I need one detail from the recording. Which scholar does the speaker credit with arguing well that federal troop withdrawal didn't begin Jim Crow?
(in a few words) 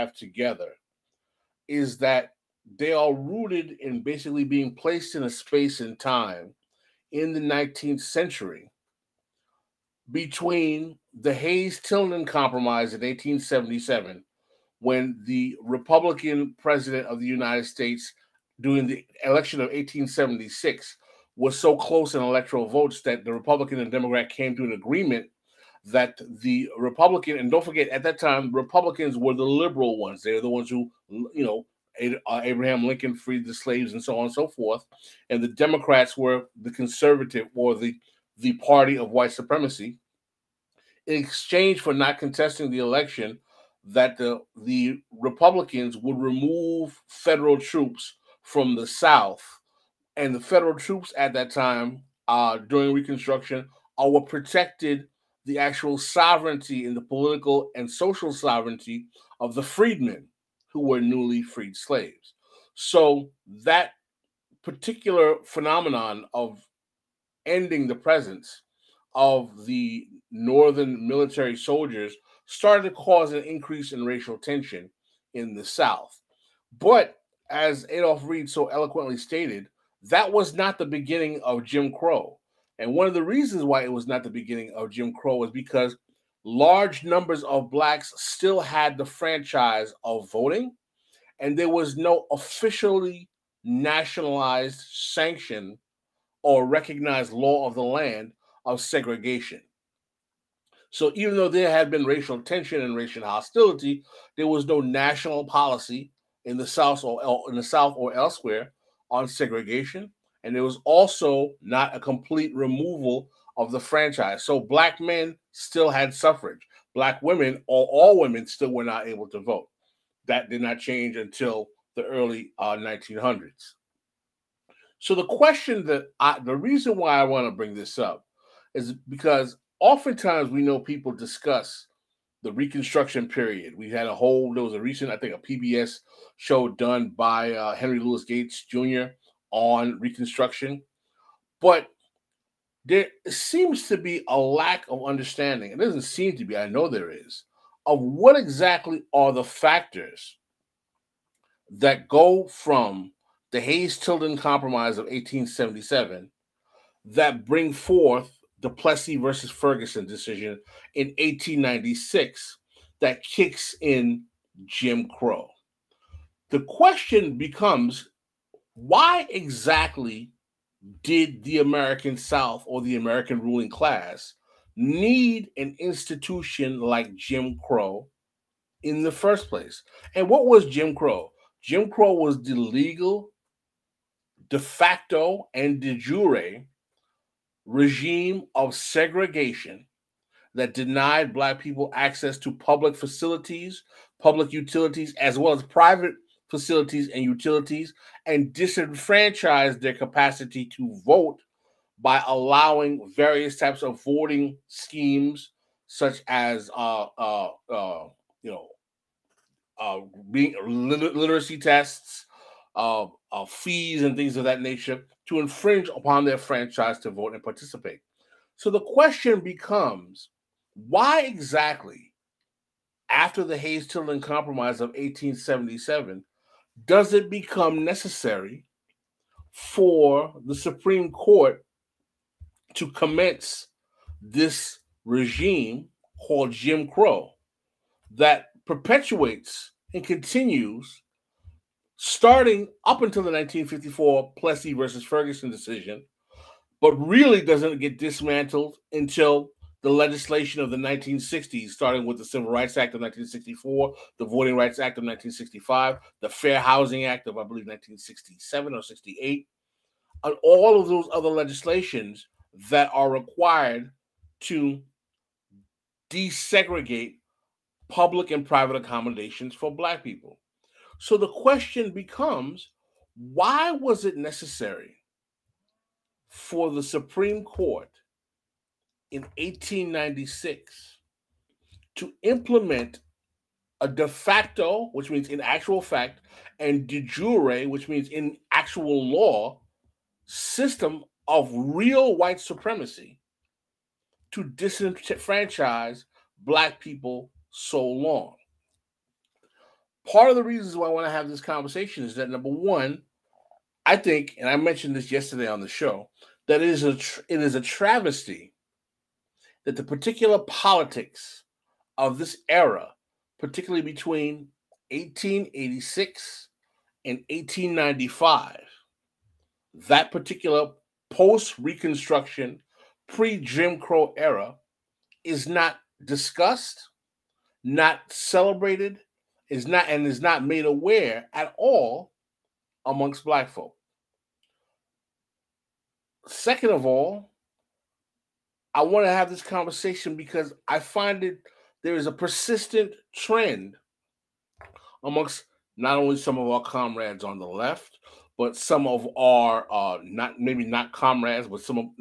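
Adolph Reed.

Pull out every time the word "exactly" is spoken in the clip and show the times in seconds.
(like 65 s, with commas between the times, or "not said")
148 s, 169 s, 221 s.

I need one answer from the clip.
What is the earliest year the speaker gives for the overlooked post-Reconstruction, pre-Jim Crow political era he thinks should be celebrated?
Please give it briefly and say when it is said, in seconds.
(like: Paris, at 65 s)
1886, at 314 s.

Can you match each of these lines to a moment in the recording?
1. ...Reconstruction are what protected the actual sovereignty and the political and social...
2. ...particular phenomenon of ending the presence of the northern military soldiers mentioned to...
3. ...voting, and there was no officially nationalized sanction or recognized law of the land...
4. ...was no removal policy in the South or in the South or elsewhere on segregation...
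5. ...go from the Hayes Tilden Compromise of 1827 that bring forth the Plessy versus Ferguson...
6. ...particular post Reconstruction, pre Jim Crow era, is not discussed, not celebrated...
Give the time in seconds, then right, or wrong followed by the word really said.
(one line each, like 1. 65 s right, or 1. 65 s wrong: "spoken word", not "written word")
1. 52 s right
2. 64 s wrong: "started", not "mentioned"
3. 90 s right
4. 104 s wrong: "national", not "removal"
5. 152 s wrong: "1877", not "1827"
6. 320 s right.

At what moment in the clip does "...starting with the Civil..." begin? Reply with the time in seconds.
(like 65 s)
251 s.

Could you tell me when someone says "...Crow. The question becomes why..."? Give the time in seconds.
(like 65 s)
165 s.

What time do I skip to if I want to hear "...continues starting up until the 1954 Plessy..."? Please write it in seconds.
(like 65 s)
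240 s.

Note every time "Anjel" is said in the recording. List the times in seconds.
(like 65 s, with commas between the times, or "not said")
not said.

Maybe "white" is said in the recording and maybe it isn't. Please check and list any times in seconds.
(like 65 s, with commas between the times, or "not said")
39 s, 292 s.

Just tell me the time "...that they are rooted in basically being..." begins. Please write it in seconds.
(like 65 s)
1 s.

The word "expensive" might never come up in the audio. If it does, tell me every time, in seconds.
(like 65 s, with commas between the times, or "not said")
not said.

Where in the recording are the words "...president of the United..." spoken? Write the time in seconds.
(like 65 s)
16 s.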